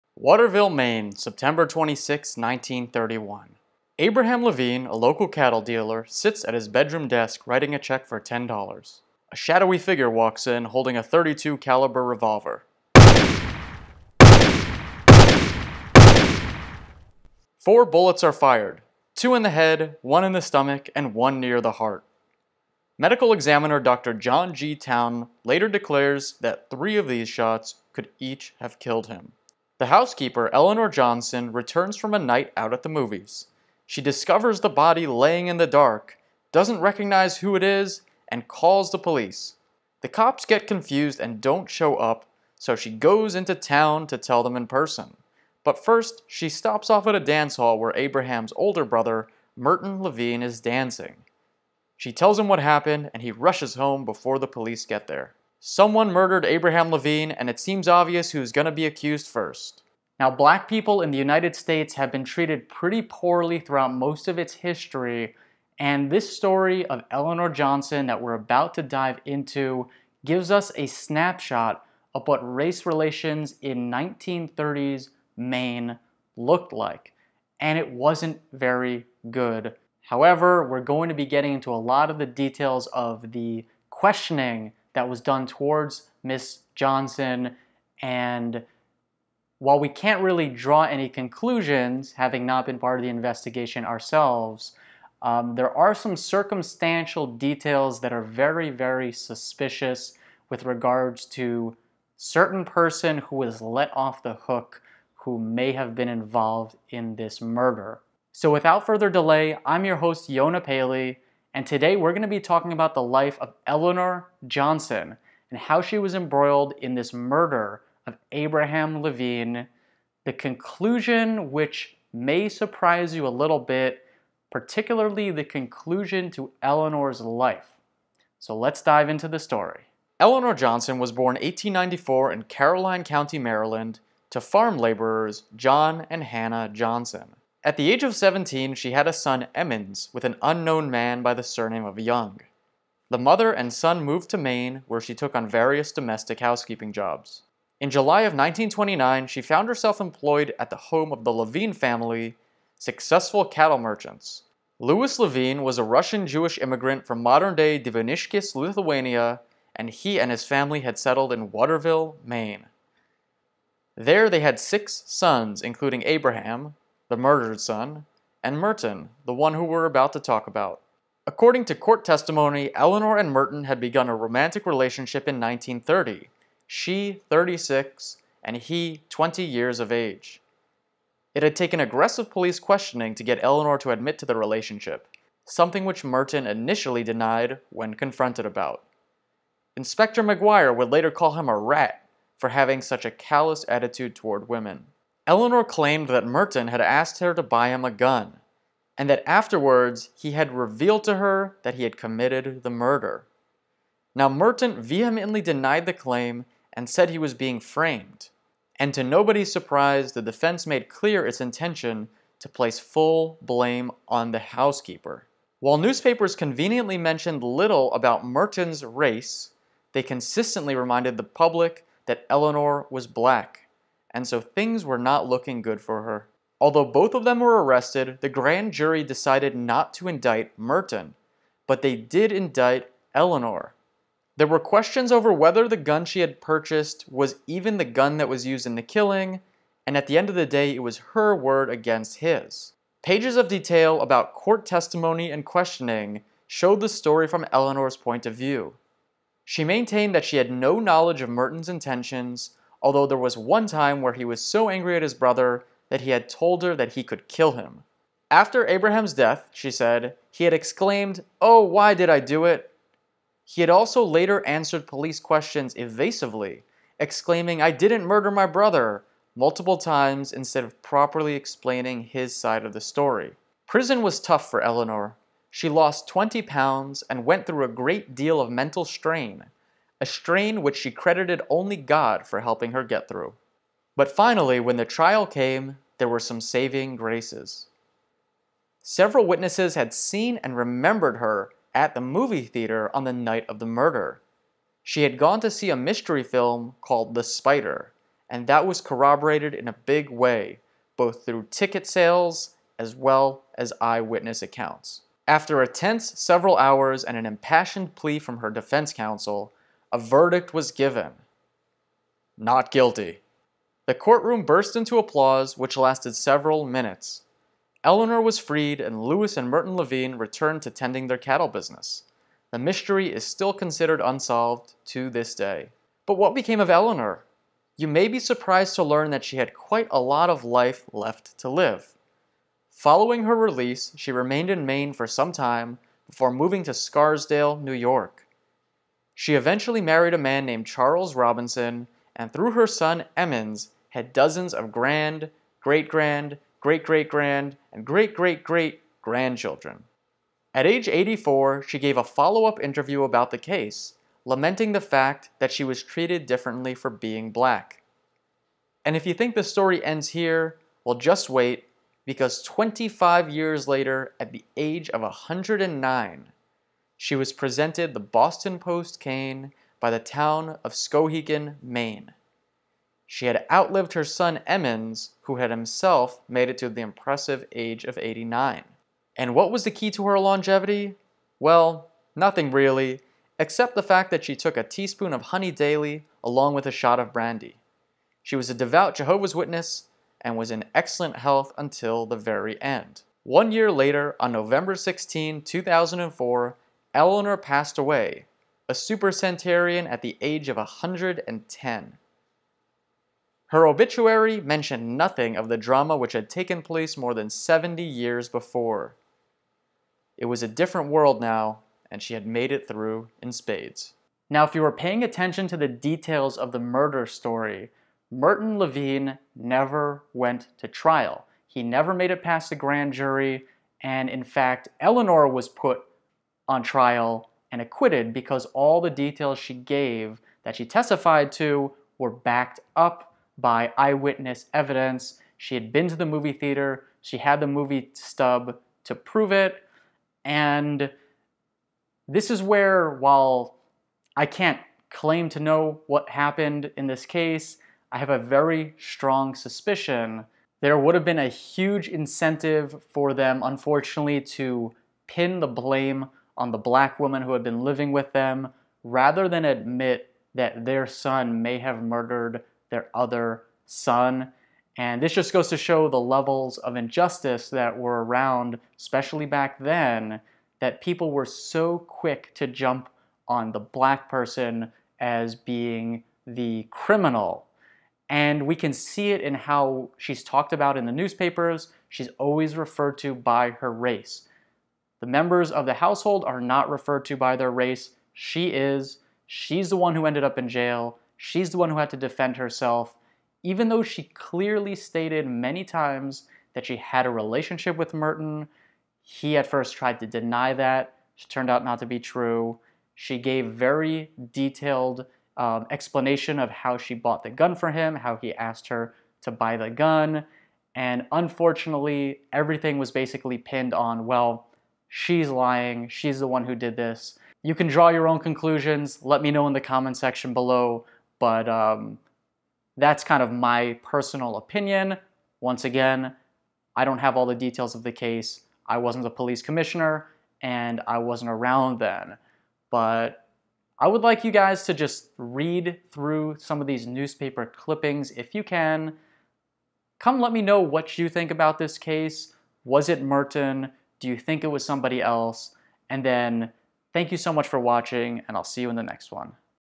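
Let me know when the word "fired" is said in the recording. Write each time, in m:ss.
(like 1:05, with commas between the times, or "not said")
0:18.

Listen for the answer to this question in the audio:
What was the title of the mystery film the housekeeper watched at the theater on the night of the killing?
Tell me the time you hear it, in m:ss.
4:57.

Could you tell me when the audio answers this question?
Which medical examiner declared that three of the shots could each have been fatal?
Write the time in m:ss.
0:23.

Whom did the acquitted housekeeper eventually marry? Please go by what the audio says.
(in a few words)
Charles Robinson.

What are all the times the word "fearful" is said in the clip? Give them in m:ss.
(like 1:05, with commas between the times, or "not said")
not said.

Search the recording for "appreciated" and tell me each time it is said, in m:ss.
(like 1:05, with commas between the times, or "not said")
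not said.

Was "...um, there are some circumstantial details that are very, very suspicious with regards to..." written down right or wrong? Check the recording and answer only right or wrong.
right.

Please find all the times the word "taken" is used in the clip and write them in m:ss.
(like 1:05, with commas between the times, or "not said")
3:01, 6:46.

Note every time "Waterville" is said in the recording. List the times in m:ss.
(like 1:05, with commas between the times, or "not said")
0:00, 2:41.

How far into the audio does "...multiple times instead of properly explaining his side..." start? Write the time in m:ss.
4:29.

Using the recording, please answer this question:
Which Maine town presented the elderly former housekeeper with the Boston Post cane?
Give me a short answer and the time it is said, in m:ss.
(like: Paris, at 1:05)
Skowhegan, at 6:10.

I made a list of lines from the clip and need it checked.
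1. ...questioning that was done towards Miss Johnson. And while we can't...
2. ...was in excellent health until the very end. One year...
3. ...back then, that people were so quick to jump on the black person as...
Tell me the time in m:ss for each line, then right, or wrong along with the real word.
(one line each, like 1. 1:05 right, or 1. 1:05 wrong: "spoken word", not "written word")
1. 1:23 right
2. 6:30 right
3. 7:49 right.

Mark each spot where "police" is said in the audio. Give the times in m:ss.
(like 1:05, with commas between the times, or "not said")
0:38, 0:54, 3:02, 4:24, 8:49.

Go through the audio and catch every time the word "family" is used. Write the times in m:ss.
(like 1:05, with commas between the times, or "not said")
2:31, 2:40.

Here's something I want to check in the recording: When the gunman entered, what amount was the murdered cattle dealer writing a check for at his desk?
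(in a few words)
$10.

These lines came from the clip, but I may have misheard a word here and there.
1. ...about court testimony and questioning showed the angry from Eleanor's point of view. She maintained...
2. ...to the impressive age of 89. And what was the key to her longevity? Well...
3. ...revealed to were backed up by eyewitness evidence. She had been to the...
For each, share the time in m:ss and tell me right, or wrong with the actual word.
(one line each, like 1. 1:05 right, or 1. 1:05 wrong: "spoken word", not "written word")
1. 4:04 wrong: "story", not "angry"
2. 6:16 right
3. 7:10 wrong: "testified", not "revealed".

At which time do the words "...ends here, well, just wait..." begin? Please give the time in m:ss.
5:59.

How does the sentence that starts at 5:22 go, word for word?
The mystery is still considered unsolved to this day.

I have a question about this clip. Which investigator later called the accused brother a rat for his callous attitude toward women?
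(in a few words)
Inspector McGuire.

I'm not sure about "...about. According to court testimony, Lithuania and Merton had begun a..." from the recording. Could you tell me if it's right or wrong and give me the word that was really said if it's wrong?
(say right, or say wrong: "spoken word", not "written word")
wrong: "Eleanor", not "Lithuania".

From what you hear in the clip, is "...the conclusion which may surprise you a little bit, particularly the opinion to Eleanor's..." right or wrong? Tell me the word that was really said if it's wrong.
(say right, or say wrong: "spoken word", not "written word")
wrong: "conclusion", not "opinion".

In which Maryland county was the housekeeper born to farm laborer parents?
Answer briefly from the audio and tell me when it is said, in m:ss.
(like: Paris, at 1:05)
Caroline County, at 2:12.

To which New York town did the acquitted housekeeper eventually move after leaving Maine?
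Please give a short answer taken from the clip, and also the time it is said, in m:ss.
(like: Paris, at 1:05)
Scarsdale, at 5:36.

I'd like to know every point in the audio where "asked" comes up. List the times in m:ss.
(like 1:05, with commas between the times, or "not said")
3:16, 8:28.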